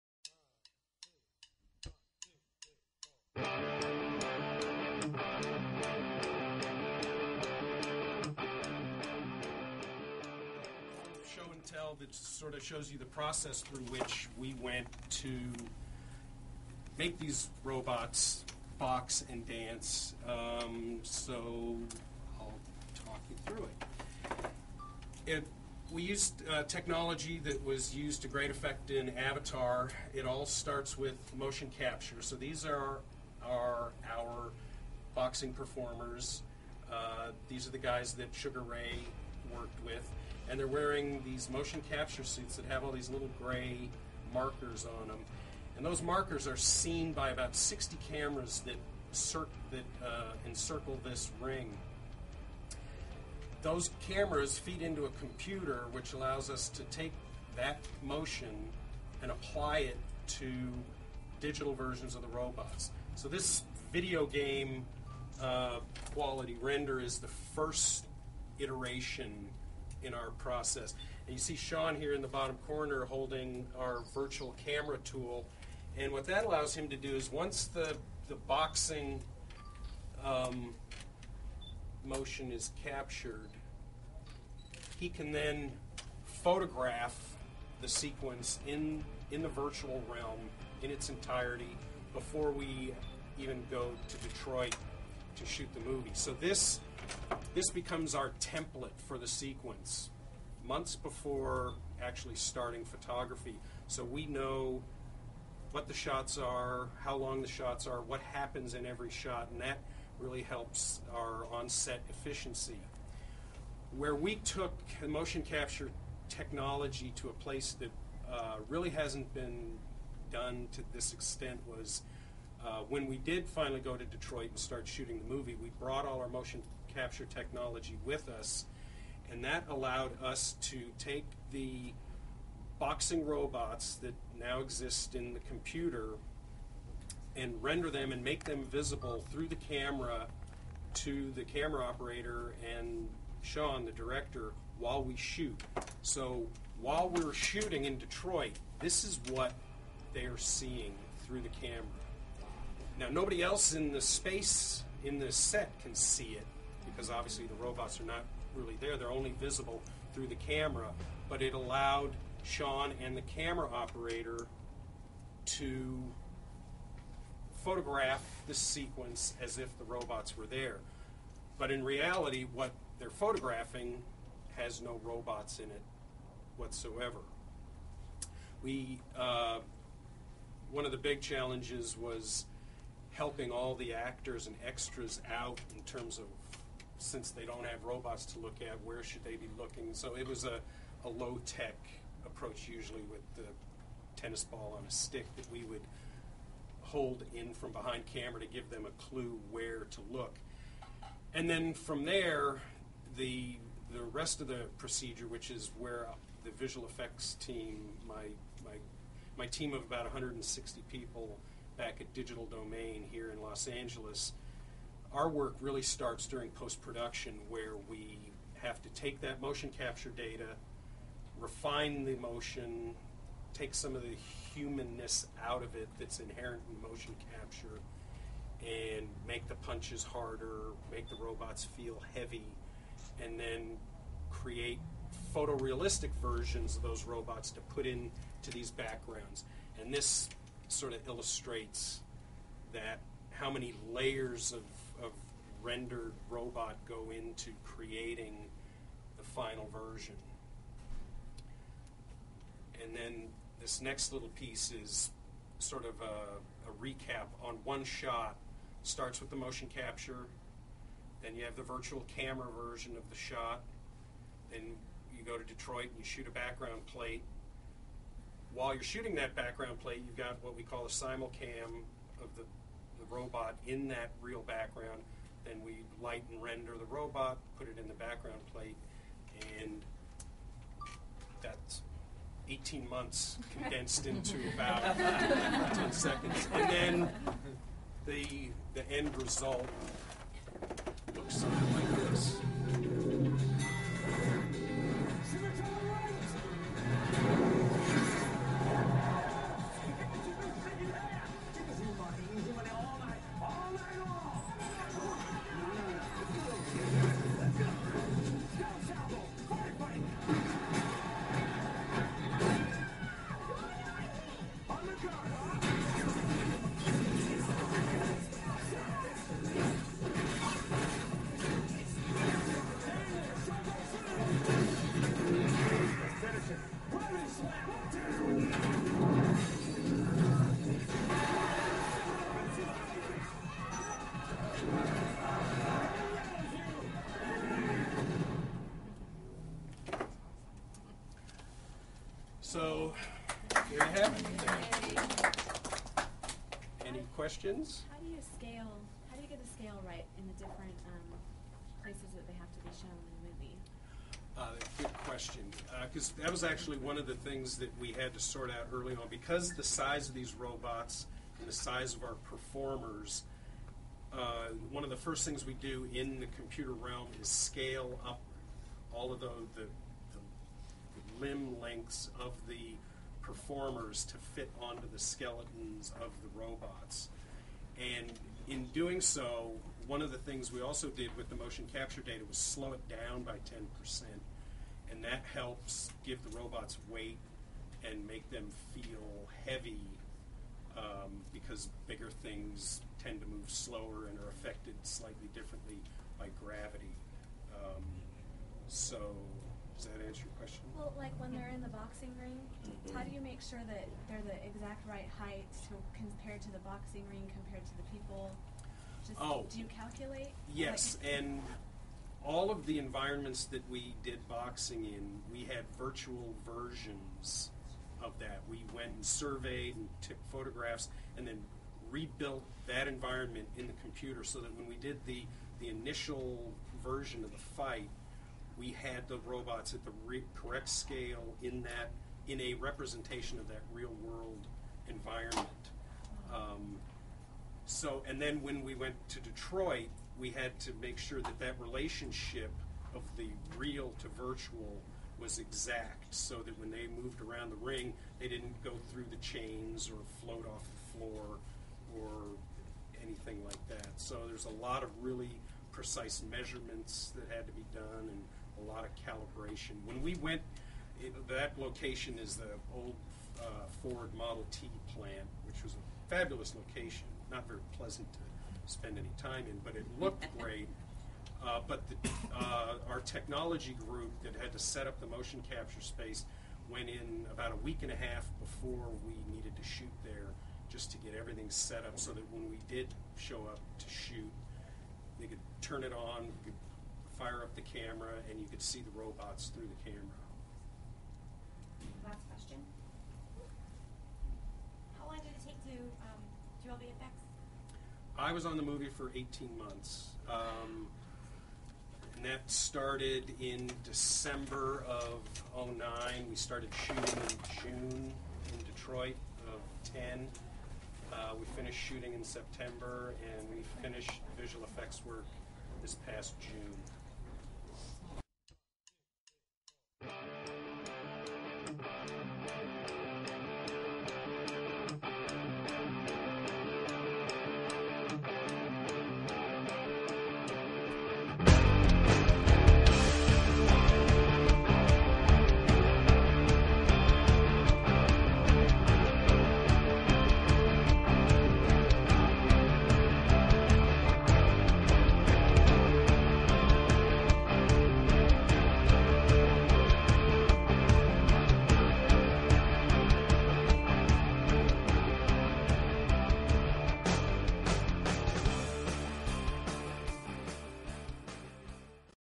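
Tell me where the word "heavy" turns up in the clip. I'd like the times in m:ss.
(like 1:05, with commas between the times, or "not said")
3:52, 6:29.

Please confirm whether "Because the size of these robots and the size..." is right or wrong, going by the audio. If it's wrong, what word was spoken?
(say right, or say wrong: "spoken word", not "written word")
right.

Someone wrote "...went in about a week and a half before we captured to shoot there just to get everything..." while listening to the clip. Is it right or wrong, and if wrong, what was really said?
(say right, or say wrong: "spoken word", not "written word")
wrong: "needed", not "captured".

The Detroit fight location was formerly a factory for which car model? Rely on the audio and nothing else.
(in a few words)
Ford Model T.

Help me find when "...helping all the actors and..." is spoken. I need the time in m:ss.
3:03.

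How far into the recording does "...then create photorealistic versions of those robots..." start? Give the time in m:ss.
3:53.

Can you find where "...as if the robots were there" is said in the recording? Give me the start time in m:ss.
2:49.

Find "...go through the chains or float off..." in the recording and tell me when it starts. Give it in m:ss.
7:28.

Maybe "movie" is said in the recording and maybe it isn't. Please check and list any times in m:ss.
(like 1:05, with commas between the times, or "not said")
1:35, 2:05, 5:53, 8:18.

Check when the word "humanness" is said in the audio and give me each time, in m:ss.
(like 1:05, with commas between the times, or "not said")
3:44.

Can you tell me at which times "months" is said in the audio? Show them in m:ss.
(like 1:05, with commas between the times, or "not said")
1:40, 4:42, 8:19.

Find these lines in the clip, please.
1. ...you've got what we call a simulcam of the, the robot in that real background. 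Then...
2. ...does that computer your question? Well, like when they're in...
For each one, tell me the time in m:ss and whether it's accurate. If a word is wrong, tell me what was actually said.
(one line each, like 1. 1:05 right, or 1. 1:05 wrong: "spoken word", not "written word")
1. 4:30 right
2. 6:39 wrong: "answer", not "computer".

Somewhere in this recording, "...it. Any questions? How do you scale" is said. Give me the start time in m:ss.
5:44.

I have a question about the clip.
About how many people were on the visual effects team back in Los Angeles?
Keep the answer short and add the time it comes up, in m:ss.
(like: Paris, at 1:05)
160, at 3:29.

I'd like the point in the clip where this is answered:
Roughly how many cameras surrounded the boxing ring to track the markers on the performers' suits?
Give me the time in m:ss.
0:47.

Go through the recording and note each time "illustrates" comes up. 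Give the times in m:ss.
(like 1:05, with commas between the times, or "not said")
4:01.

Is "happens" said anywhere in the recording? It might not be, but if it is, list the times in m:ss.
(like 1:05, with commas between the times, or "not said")
1:48.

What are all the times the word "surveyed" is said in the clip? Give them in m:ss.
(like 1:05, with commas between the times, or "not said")
6:59.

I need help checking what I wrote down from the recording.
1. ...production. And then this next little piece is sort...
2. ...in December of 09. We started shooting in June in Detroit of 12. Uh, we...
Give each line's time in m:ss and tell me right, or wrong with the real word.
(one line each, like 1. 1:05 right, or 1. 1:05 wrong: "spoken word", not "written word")
1. 4:09 wrong: "version", not "production"
2. 8:23 wrong: "10", not "12".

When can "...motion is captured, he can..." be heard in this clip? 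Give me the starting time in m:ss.
1:22.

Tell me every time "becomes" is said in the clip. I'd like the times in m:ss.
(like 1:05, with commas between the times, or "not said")
1:37.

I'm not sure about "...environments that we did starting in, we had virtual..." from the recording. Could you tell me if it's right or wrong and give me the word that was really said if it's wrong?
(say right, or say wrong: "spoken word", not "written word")
wrong: "boxing", not "starting".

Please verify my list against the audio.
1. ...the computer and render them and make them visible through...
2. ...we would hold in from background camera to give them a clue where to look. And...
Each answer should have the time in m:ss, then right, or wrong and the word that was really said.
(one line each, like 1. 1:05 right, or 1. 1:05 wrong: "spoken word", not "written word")
1. 2:15 right
2. 3:15 wrong: "behind", not "background".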